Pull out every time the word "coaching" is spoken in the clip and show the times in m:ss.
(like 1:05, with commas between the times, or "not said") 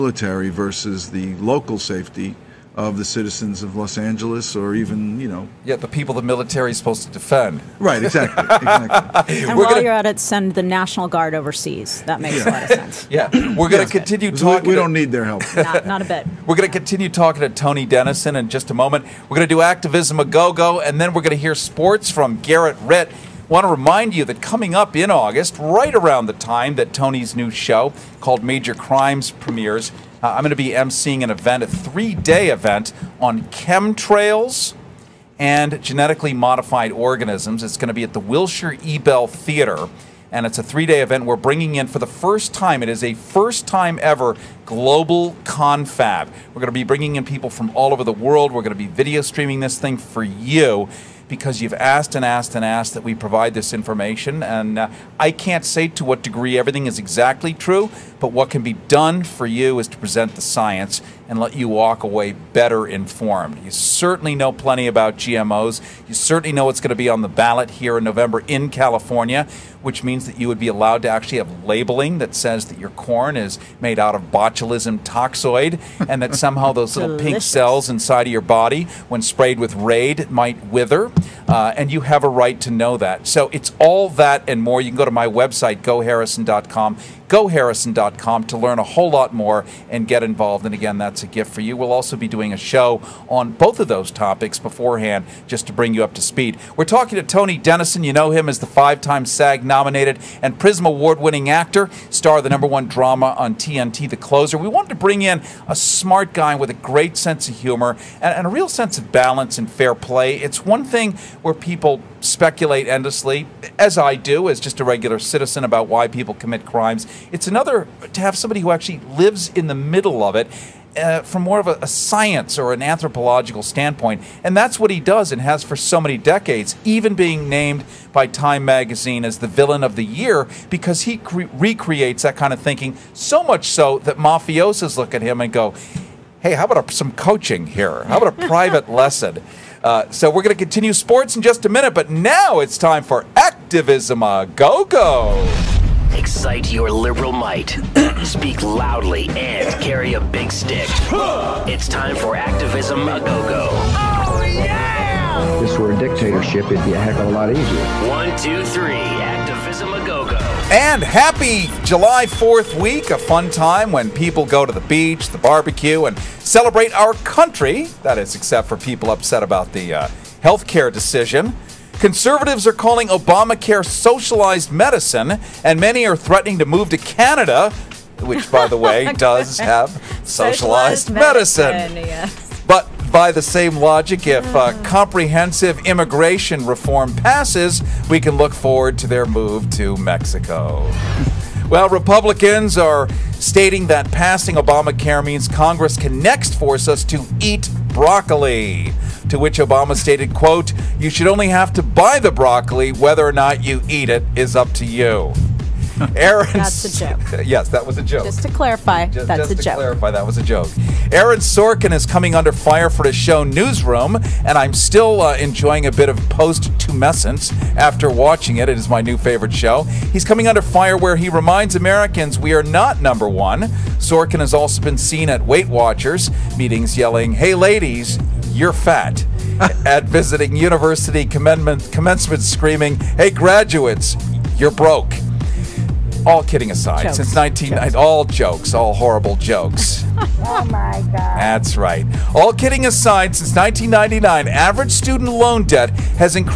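2:17.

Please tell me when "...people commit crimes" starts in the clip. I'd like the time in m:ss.
1:56.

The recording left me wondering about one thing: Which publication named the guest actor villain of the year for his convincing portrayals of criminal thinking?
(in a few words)
Time magazine.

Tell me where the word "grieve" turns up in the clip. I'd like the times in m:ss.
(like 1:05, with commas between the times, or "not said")
not said.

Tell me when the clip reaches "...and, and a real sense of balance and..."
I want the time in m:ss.
1:48.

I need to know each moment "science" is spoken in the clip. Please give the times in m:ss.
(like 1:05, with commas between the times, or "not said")
1:00, 2:01.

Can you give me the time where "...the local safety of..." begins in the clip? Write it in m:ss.
0:01.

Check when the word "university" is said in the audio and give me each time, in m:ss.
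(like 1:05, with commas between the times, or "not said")
3:50.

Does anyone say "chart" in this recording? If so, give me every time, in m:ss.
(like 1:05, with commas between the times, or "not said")
not said.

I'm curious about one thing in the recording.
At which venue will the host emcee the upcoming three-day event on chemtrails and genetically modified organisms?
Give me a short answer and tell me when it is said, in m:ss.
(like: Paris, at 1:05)
Wilshire Ebell Theater, at 0:38.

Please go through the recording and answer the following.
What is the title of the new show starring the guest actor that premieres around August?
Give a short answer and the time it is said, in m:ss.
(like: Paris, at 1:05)
Major Crimes, at 0:28.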